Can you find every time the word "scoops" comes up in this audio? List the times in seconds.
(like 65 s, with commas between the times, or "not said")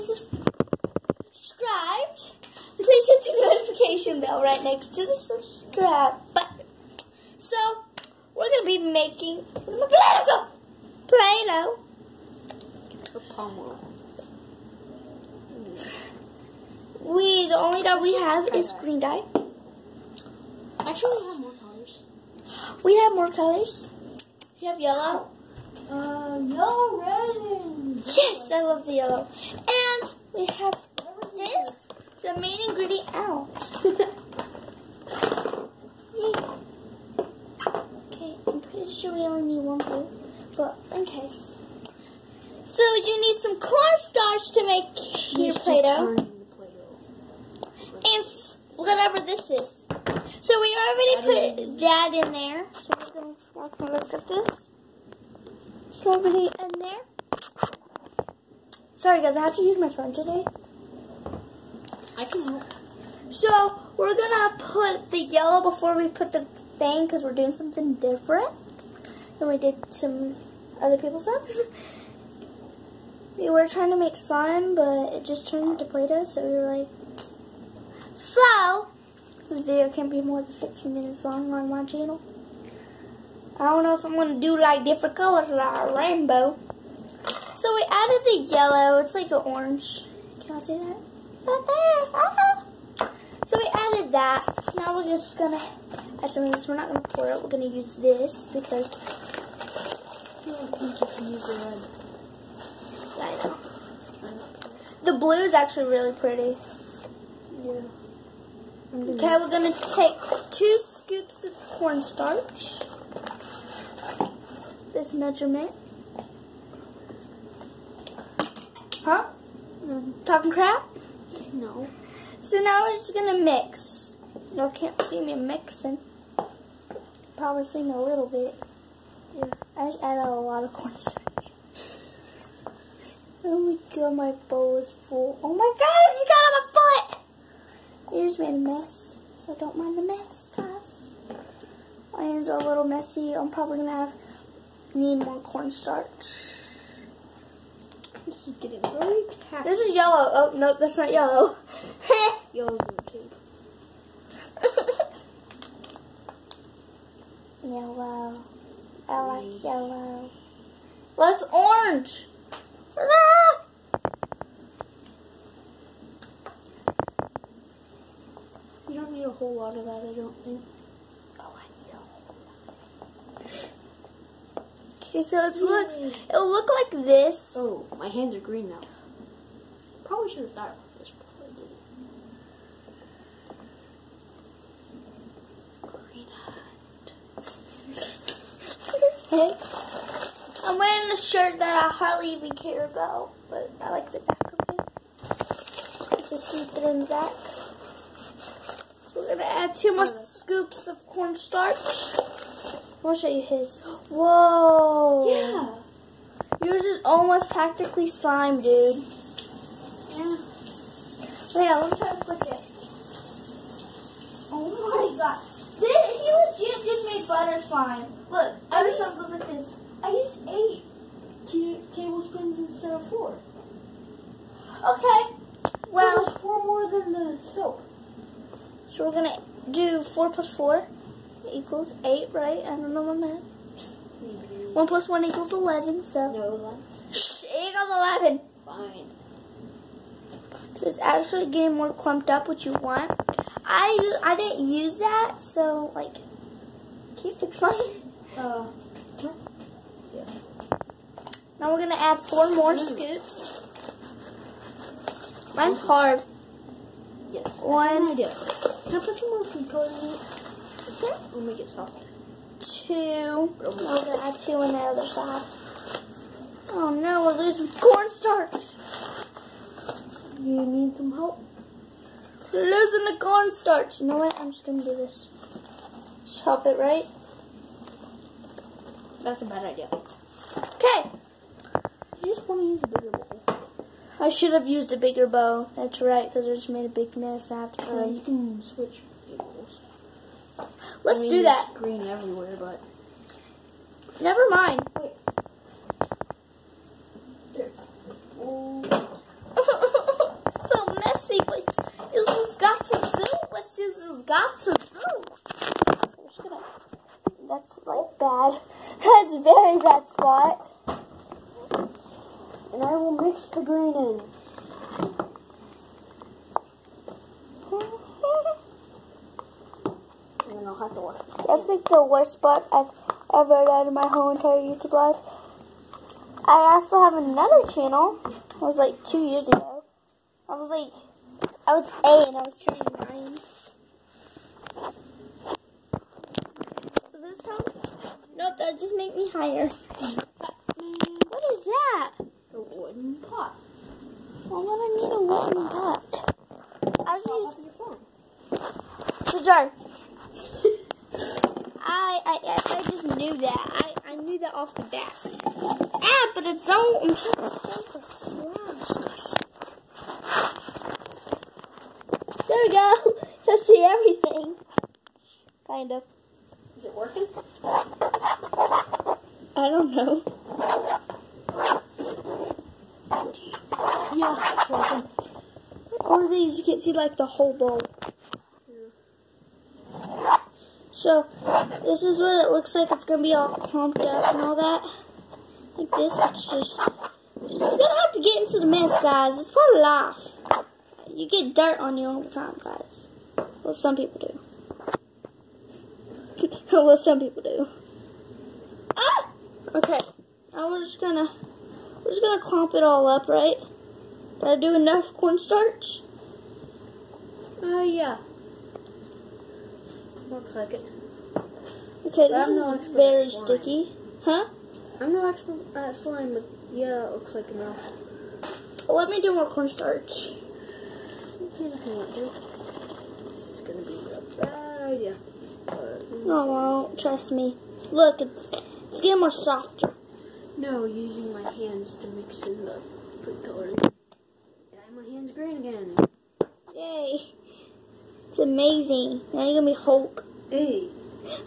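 110 s, 200 s, 252 s.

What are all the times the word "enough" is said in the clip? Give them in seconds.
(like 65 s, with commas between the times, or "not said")
404 s, 417 s.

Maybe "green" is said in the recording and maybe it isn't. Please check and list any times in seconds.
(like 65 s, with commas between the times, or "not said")
18 s, 178 s, 291 s, 313 s, 435 s.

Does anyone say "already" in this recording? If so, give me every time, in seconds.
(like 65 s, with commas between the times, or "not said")
50 s, 56 s.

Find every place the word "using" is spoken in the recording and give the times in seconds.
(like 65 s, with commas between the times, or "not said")
347 s, 430 s.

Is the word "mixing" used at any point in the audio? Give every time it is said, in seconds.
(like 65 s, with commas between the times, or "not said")
125 s.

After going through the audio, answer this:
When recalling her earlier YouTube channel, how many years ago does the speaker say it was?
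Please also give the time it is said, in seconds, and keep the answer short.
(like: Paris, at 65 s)
2 years, at 329 s.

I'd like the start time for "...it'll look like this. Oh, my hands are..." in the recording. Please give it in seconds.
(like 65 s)
176 s.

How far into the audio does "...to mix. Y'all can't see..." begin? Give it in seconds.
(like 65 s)
123 s.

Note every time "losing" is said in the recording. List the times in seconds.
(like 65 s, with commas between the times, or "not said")
267 s, 272 s.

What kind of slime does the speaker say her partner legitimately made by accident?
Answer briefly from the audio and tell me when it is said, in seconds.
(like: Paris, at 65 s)
butter slime, at 217 s.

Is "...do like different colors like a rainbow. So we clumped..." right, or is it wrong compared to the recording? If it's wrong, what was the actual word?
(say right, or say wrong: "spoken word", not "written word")
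wrong: "added", not "clumped".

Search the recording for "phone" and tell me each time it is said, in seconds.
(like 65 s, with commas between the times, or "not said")
59 s, 348 s.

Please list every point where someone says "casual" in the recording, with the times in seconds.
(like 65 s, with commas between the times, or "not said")
not said.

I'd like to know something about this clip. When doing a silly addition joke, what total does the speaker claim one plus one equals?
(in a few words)
11.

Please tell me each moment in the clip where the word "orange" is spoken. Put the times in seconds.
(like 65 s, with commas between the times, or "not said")
89 s, 161 s.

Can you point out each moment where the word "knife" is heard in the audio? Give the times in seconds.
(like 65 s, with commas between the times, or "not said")
not said.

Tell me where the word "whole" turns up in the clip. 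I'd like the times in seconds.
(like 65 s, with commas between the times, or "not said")
169 s, 324 s, 377 s.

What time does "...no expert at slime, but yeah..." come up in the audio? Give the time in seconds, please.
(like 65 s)
415 s.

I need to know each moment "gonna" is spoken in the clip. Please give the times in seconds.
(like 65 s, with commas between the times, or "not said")
143 s, 199 s, 263 s, 274 s, 423 s, 439 s.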